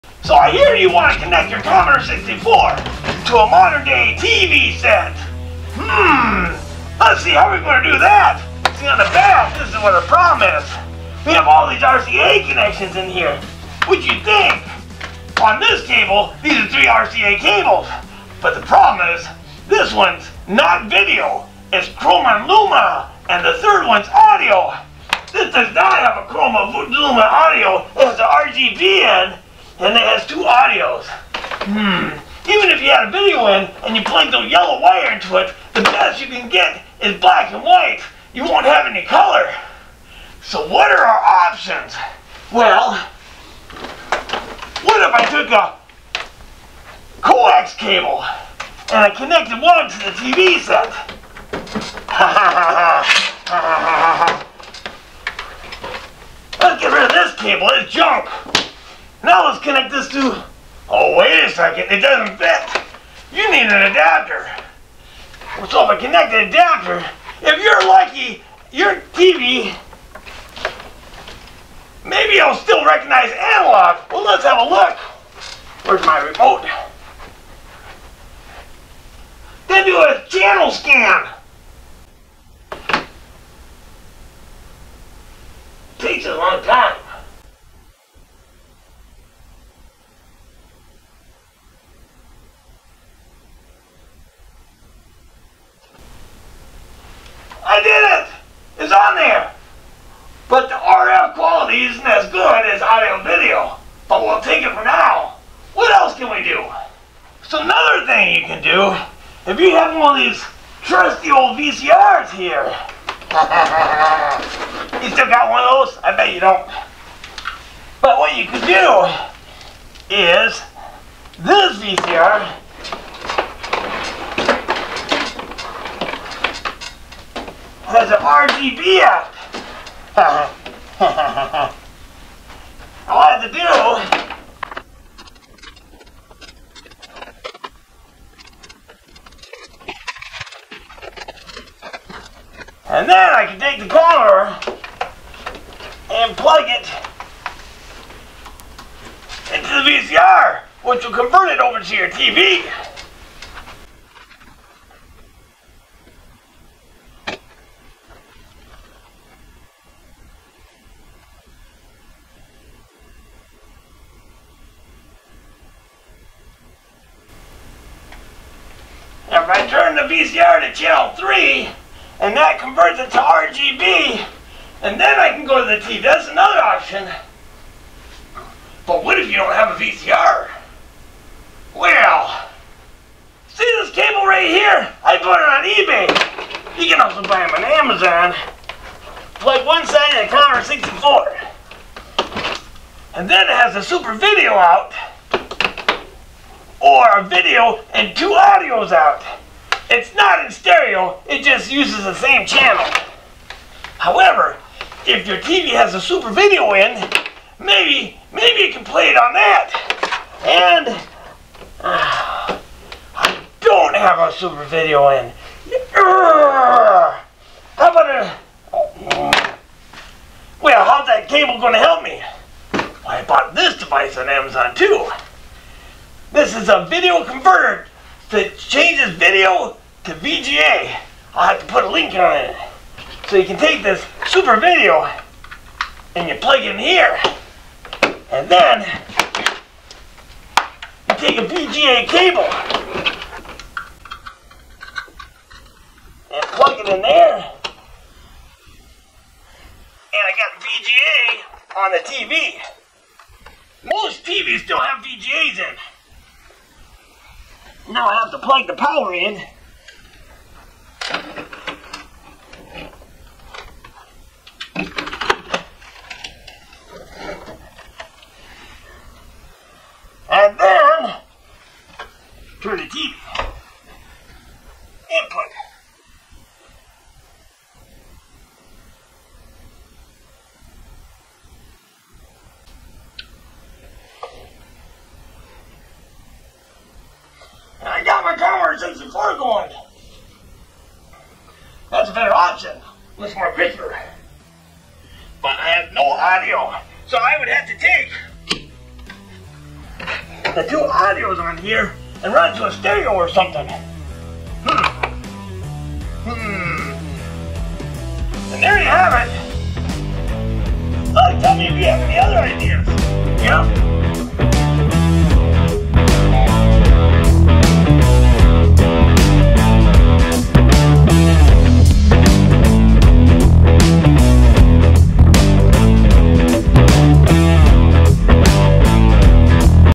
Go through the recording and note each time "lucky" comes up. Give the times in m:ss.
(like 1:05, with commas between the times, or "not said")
1:07.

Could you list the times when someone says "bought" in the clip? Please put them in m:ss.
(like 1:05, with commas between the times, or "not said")
3:05, 3:43.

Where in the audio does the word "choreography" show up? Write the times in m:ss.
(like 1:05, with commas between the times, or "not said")
not said.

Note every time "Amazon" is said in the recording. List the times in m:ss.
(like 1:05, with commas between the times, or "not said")
3:07, 3:44.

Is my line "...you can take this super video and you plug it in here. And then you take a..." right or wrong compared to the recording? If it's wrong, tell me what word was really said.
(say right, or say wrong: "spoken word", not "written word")
right.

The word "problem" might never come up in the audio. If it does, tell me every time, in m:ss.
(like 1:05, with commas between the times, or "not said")
0:10, 0:18.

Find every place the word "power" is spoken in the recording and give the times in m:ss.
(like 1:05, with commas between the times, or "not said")
4:18.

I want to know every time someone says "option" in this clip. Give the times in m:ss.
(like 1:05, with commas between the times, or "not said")
0:41, 2:56, 4:52.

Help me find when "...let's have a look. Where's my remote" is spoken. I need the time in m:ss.
1:14.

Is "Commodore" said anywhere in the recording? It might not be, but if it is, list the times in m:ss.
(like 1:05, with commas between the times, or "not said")
0:01, 2:23, 3:10.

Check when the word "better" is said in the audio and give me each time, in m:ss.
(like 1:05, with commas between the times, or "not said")
4:52.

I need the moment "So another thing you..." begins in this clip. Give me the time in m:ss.
1:47.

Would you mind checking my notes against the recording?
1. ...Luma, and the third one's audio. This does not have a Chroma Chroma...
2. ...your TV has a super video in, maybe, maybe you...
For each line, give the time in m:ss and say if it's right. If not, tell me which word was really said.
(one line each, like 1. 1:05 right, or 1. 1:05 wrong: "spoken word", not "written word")
1. 0:22 wrong: "Luma", not "Chroma"
2. 3:25 right.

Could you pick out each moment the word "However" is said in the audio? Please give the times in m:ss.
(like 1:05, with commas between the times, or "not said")
3:23.